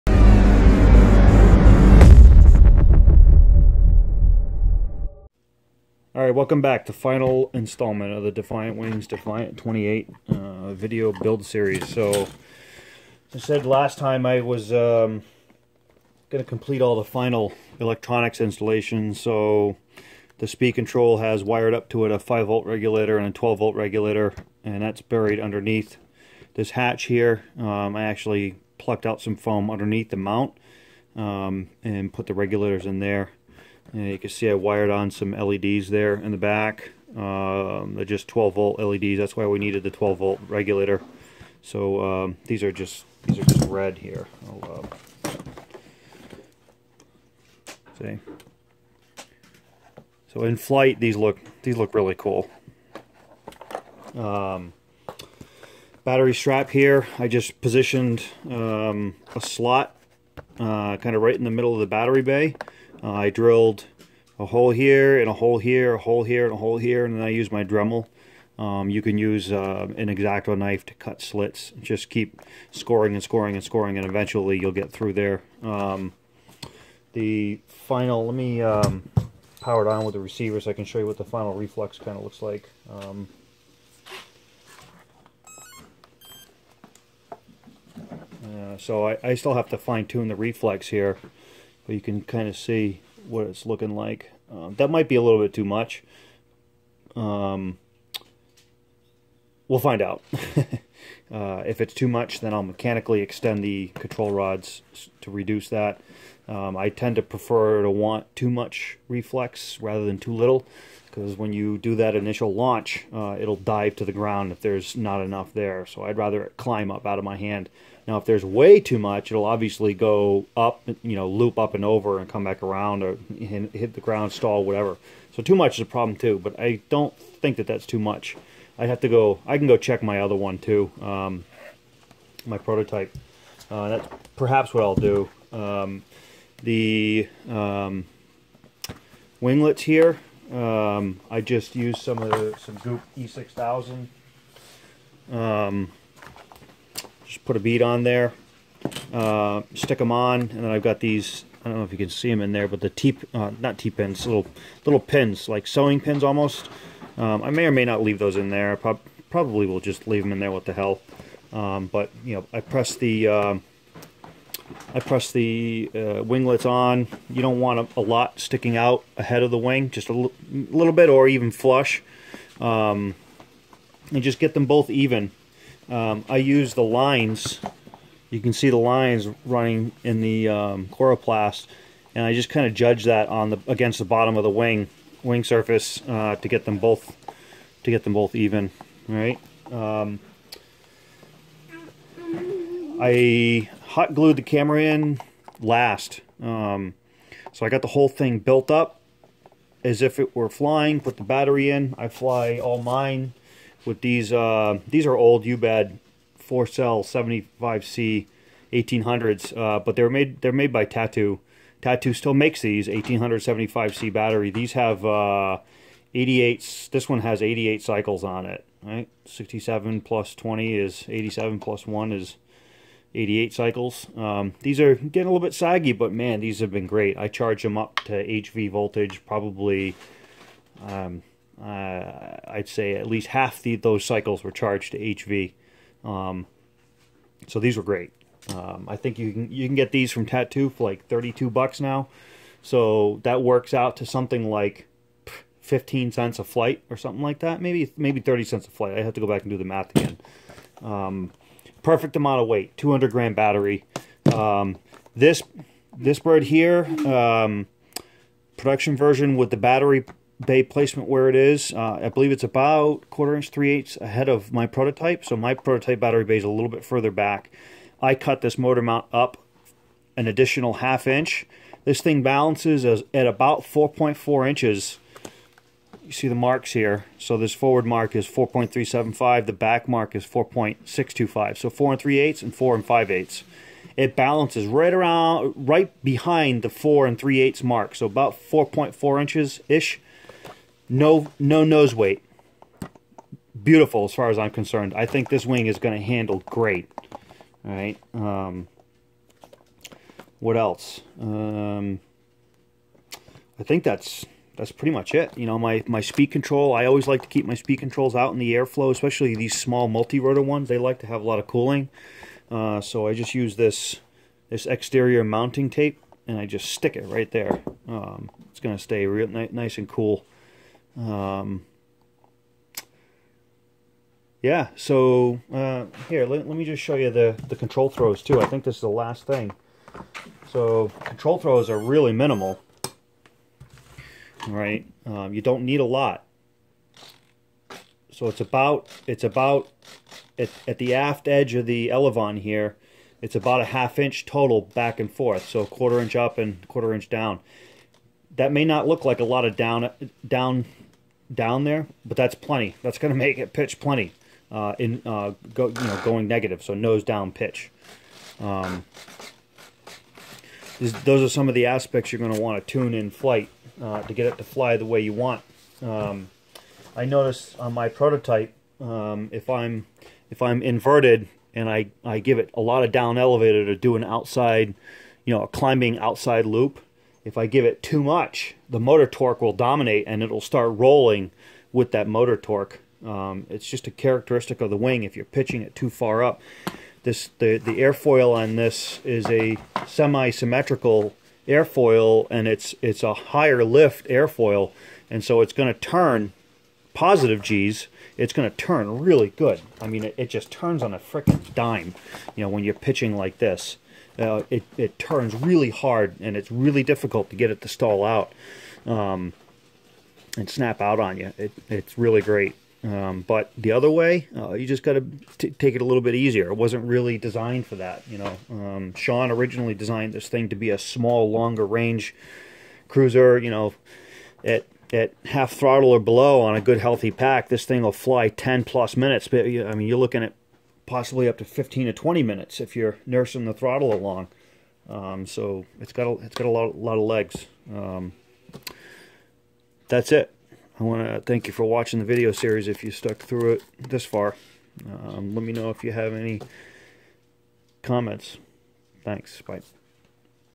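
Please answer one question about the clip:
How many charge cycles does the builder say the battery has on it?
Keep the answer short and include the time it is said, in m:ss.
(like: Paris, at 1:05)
88, at 3:36.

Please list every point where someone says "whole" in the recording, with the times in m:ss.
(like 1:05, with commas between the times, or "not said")
3:17.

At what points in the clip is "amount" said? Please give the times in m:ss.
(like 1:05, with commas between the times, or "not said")
4:12.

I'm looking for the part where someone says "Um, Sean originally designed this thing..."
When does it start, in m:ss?
6:58.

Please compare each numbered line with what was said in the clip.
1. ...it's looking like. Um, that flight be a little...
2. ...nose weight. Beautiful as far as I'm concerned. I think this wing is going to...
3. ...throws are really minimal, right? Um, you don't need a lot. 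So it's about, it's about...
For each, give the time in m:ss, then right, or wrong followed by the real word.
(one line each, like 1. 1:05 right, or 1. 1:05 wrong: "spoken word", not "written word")
1. 1:33 wrong: "might", not "flight"
2. 4:51 right
3. 5:31 right.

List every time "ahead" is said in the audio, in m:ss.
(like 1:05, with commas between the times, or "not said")
2:49, 4:23.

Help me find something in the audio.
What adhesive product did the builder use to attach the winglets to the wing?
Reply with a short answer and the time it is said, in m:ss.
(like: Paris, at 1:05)
Goop E6000, at 2:22.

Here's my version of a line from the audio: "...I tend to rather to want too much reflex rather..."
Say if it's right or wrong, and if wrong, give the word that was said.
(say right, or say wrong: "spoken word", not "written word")
wrong: "prefer", not "rather".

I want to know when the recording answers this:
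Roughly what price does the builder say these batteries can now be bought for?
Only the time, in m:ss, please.
4:01.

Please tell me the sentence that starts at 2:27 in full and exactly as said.
Just put a bead on there, uh, stick them on, and then I've got these.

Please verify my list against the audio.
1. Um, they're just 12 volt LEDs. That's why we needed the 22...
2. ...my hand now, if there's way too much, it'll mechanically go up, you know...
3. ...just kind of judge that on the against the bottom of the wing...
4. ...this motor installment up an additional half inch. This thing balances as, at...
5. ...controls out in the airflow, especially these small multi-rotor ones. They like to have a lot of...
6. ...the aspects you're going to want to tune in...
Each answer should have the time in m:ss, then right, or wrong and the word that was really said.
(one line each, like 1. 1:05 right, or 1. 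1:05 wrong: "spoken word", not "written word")
1. 0:37 wrong: "12", not "22"
2. 1:57 wrong: "obviously", not "mechanically"
3. 3:02 right
4. 4:28 wrong: "mount", not "installment"
5. 5:07 right
6. 6:01 right.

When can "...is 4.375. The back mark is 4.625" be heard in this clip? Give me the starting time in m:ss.
4:38.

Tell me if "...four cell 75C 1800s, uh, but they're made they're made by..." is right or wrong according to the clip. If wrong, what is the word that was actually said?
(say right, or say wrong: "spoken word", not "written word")
right.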